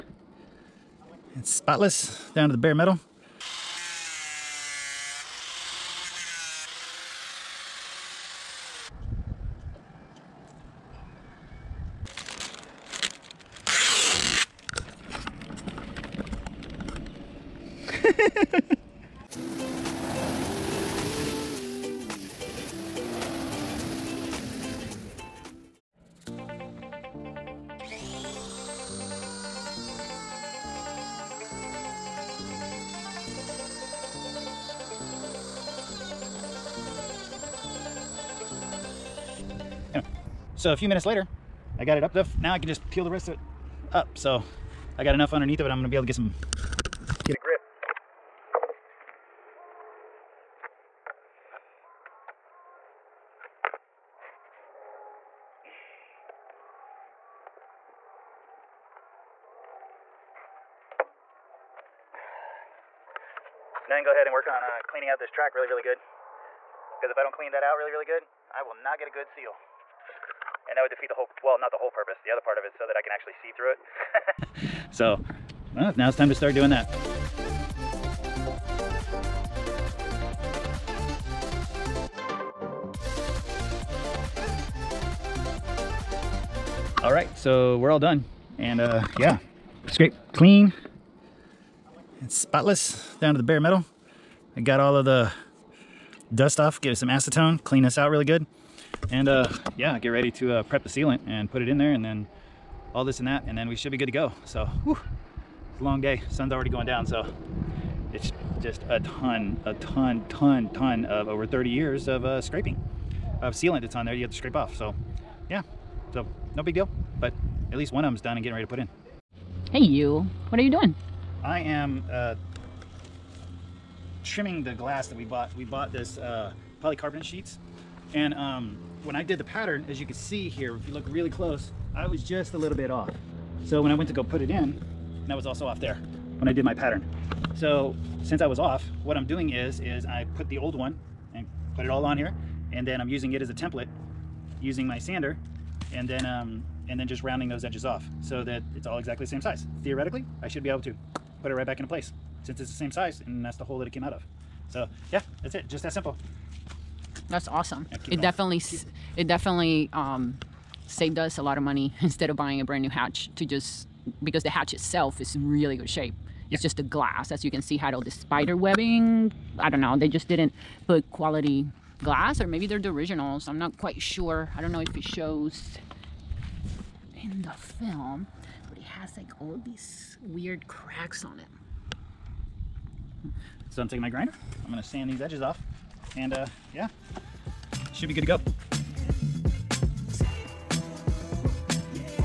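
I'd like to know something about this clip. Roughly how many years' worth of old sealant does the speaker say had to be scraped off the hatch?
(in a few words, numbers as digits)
over 30 years.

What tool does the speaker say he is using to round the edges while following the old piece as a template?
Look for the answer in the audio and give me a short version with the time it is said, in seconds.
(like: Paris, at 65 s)
sander, at 144 s.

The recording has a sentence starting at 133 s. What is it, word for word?
So when I went to go put it in, and I was also off there when I did my pattern.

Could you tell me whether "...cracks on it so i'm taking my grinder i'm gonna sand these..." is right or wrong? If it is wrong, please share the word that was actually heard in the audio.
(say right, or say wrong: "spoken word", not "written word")
right.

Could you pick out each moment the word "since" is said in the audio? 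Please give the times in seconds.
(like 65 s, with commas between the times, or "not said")
138 s, 152 s.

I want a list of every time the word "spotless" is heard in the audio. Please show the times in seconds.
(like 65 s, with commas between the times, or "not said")
1 s, 92 s.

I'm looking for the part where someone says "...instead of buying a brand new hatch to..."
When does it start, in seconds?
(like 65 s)
162 s.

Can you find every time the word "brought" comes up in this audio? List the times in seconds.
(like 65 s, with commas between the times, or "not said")
not said.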